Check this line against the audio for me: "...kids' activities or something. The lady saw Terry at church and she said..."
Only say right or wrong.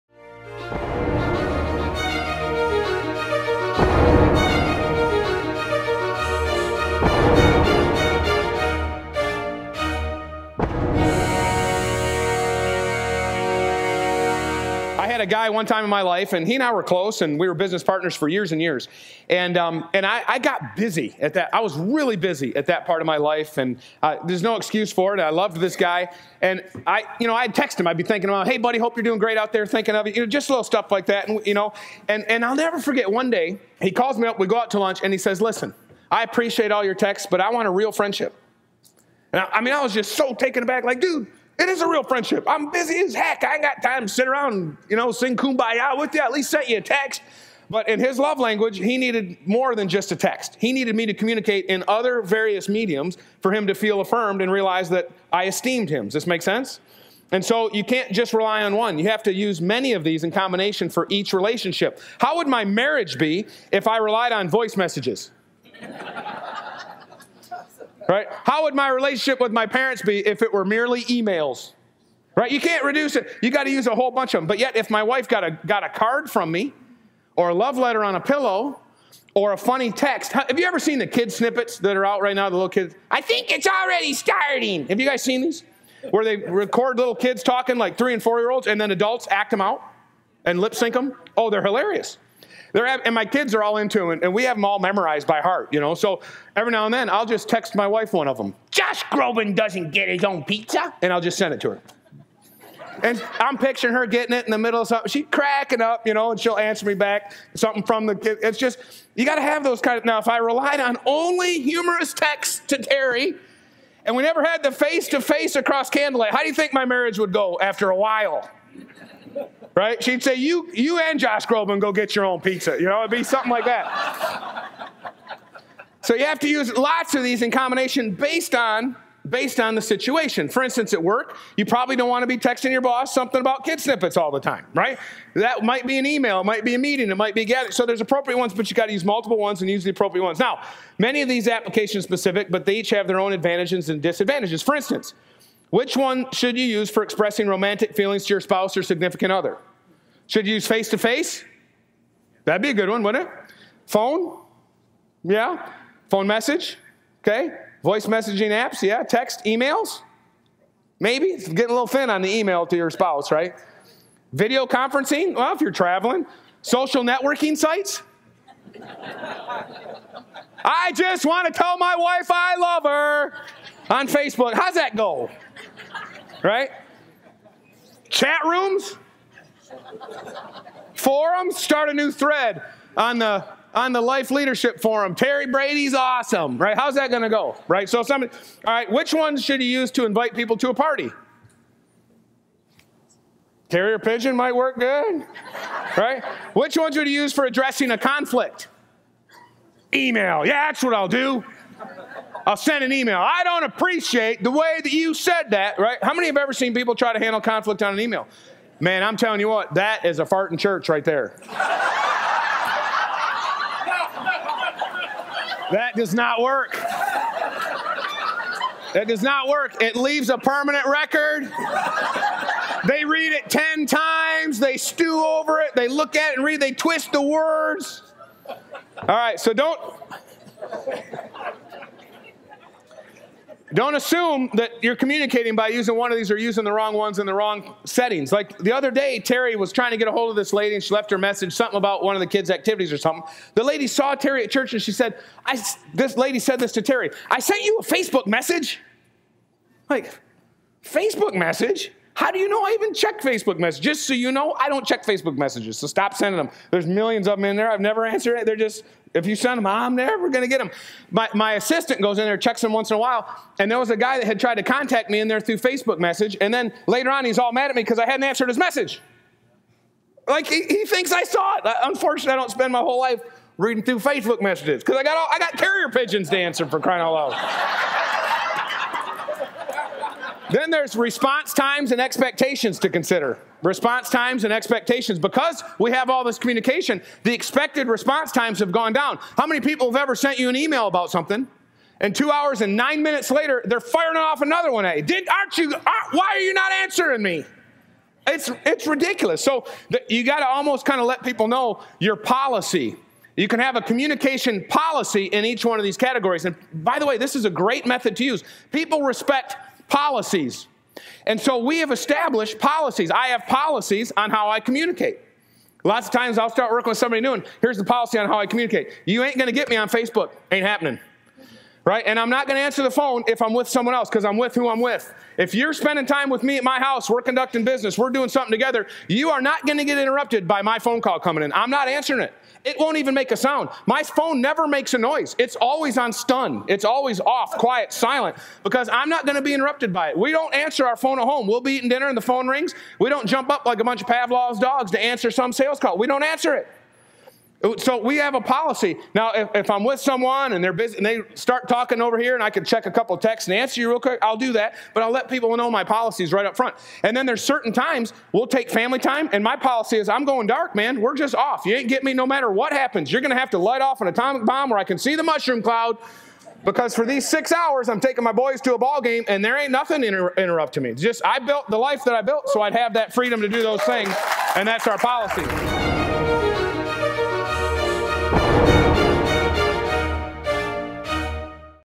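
right.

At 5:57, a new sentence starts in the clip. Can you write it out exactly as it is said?
And then there's certain times we'll take family time.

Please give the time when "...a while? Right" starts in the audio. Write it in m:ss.
1:57.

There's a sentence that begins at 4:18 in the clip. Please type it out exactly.
They're just if you send them, I'm never going to get them.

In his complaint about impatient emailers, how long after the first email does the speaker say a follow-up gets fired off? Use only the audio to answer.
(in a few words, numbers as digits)
2 hours and 9 minutes.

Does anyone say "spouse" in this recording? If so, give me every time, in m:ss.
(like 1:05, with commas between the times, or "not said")
2:28, 2:42.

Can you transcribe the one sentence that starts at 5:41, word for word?
We'll be eating dinner and the phone rings.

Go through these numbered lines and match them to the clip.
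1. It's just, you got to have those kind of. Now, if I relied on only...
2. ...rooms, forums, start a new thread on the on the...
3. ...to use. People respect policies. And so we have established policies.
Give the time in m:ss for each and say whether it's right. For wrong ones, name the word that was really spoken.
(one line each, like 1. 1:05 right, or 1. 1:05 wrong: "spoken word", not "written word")
1. 1:48 right
2. 2:58 right
3. 5:08 right.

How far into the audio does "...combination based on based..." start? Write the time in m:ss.
2:07.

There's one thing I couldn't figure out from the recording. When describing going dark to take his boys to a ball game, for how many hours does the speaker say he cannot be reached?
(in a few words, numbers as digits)
6.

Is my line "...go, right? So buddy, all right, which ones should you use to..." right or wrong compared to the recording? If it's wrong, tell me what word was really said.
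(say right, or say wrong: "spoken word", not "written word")
wrong: "somebody", not "buddy".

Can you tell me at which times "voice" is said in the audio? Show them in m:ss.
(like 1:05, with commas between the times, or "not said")
1:04, 2:37.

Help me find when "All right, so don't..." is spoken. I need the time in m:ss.
3:48.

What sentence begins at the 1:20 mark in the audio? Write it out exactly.
Have you ever seen the kid snippets that are out right now, the little kids?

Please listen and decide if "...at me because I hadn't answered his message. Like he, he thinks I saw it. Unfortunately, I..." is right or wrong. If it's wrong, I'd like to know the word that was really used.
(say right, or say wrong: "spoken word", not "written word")
right.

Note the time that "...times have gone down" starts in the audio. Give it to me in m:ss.
4:48.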